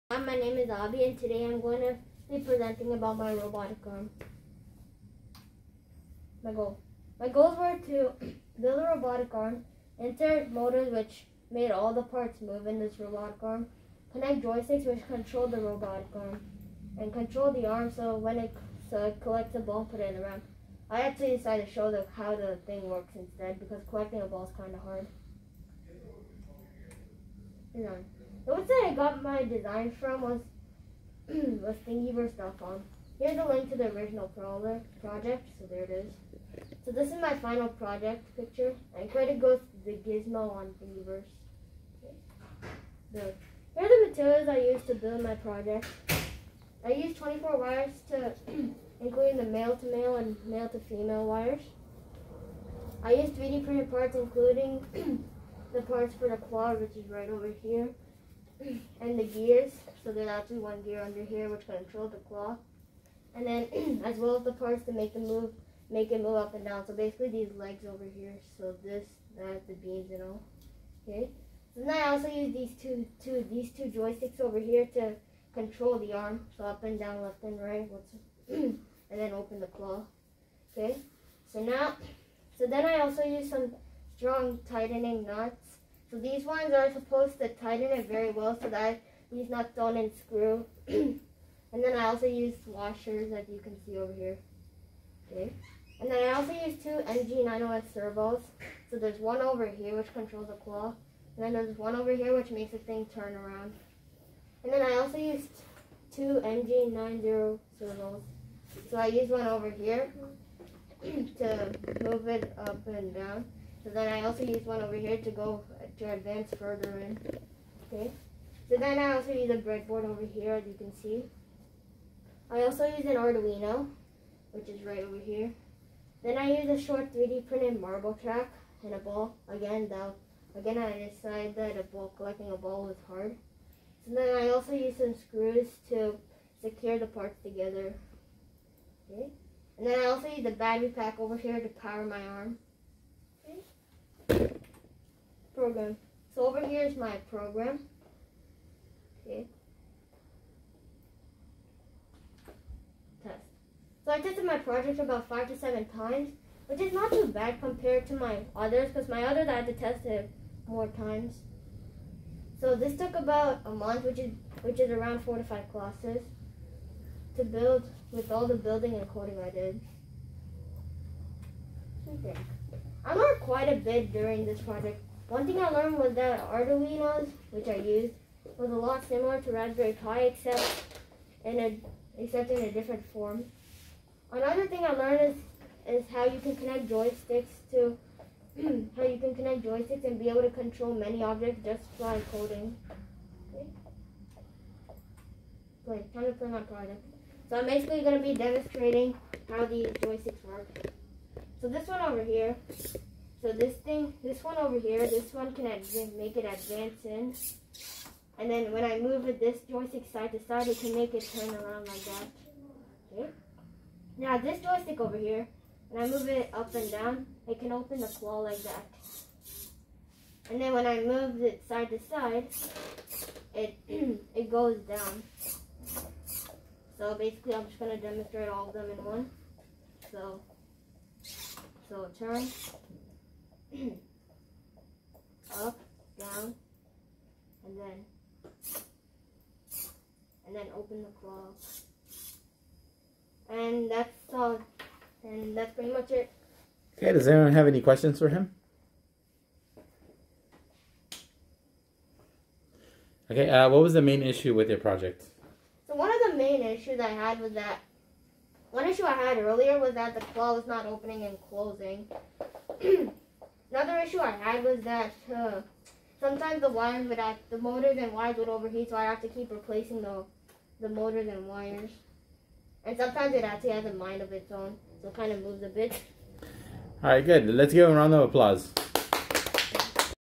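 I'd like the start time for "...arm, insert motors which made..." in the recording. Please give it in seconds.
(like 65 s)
9 s.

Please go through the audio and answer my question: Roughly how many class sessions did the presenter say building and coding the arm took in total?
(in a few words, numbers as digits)
4 to 5.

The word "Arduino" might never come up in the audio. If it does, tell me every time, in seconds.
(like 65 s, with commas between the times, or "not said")
123 s, 176 s.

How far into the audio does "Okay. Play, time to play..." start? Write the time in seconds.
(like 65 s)
193 s.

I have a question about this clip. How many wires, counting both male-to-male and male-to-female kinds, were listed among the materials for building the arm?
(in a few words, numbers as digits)
24.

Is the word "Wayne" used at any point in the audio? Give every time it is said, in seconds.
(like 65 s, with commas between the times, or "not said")
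not said.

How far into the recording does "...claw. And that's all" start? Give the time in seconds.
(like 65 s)
241 s.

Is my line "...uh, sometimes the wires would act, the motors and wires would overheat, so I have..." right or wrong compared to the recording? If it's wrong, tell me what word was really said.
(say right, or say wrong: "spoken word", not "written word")
right.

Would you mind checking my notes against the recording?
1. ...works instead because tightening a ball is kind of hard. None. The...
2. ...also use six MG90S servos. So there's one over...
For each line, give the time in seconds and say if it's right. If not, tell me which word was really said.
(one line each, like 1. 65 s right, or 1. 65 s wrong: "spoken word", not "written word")
1. 22 s wrong: "collecting", not "tightening"
2. 96 s wrong: "two", not "six".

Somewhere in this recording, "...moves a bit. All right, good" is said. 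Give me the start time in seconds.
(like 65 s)
275 s.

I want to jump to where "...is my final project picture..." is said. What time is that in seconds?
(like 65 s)
37 s.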